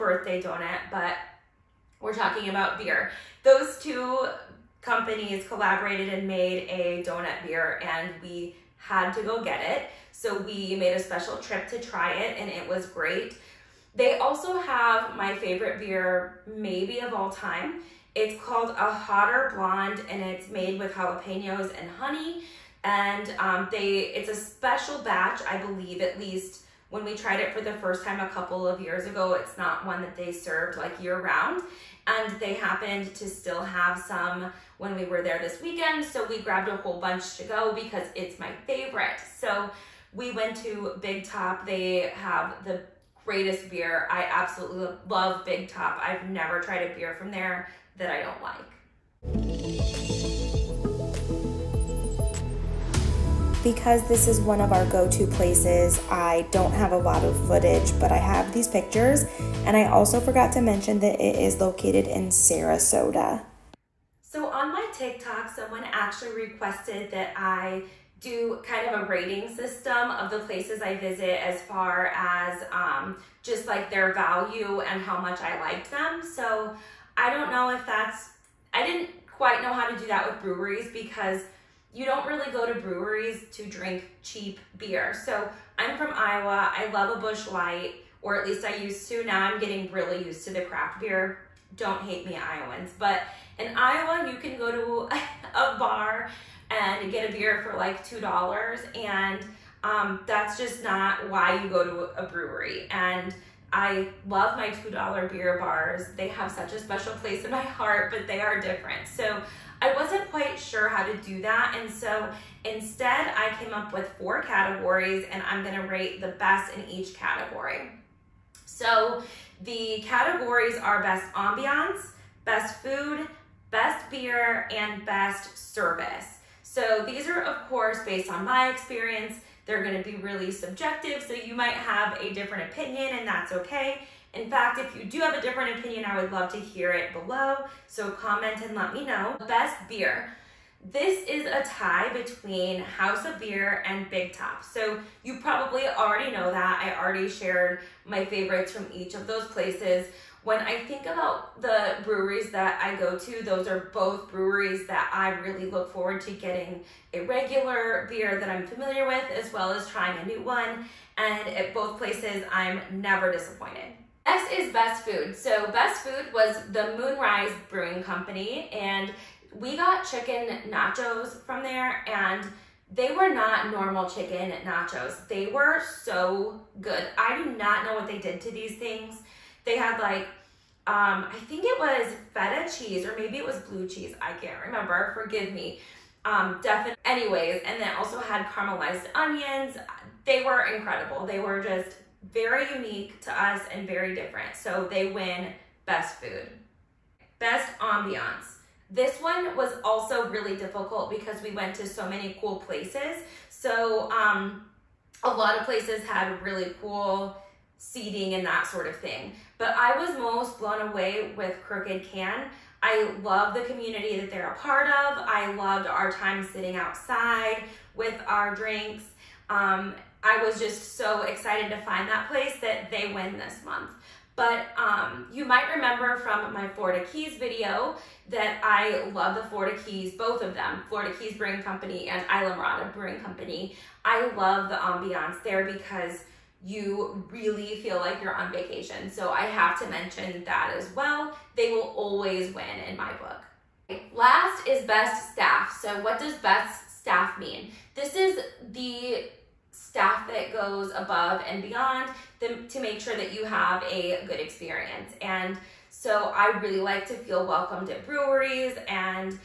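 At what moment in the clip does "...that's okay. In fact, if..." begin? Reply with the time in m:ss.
2:13.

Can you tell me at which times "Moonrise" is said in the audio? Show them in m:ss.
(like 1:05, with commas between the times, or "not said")
2:46.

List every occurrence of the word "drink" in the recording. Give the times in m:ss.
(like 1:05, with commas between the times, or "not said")
1:23, 3:38.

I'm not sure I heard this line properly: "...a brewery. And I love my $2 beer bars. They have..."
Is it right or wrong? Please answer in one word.
right.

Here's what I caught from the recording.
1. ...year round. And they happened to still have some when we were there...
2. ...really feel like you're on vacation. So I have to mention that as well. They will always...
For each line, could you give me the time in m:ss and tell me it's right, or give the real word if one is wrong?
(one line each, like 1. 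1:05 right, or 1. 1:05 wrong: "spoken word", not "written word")
1. 0:31 right
2. 3:57 right.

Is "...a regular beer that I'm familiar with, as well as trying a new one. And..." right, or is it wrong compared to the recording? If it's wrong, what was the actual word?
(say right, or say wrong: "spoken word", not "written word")
right.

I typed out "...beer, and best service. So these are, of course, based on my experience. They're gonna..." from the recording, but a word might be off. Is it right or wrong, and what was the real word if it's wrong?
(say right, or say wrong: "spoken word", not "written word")
right.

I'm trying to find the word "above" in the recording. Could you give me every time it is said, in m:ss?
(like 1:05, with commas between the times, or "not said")
4:10.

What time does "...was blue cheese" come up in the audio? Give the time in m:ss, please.
3:03.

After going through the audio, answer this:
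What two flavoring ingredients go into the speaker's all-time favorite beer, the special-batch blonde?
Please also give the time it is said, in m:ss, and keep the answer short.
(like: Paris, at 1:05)
jalapenos and honey, at 0:20.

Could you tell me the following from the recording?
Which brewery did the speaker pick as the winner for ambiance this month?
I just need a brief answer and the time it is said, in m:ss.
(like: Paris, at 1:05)
Crooked Can, at 3:31.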